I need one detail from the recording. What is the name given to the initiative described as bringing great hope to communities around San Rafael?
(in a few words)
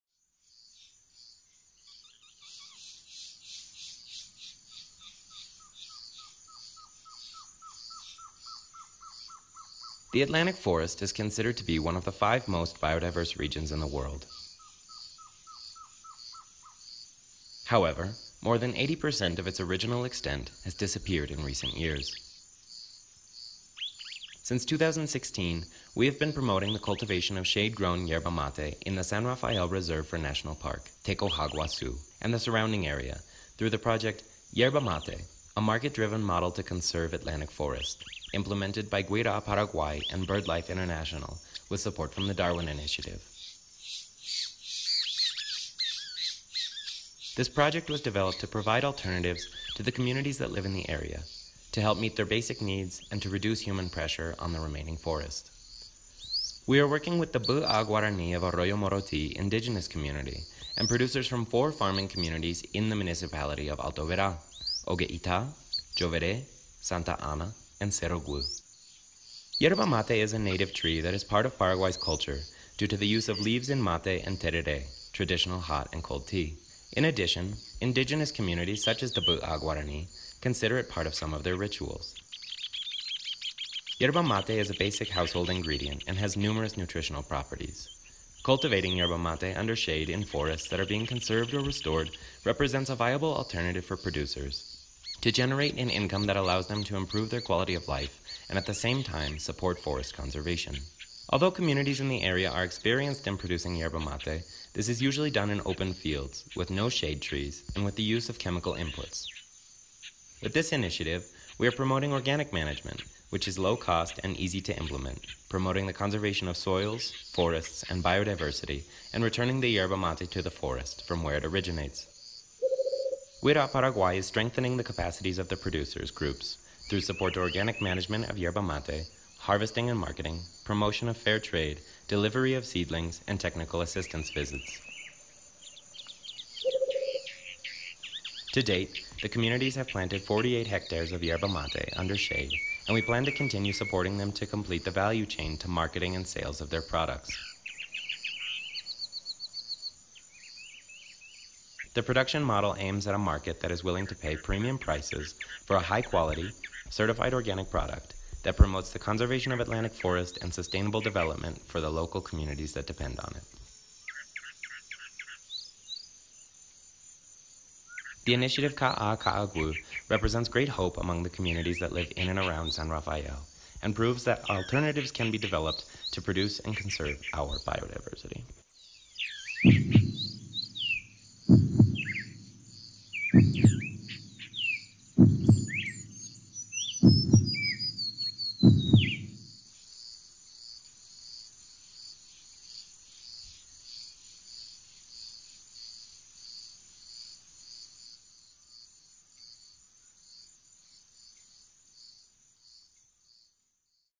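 Ka'a Ka'agwu.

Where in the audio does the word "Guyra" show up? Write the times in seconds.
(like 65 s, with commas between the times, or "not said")
39 s, 123 s.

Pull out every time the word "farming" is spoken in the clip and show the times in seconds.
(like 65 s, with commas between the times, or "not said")
61 s.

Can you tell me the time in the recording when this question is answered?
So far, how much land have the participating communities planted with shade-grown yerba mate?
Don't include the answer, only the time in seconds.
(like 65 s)
140 s.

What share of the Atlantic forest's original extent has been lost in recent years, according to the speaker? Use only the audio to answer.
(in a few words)
more than 80%.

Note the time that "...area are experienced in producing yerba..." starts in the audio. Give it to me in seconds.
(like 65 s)
102 s.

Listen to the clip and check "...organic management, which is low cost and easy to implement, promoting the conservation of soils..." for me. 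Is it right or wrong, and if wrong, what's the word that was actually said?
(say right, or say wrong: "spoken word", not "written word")
right.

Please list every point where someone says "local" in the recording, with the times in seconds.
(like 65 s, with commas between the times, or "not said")
161 s.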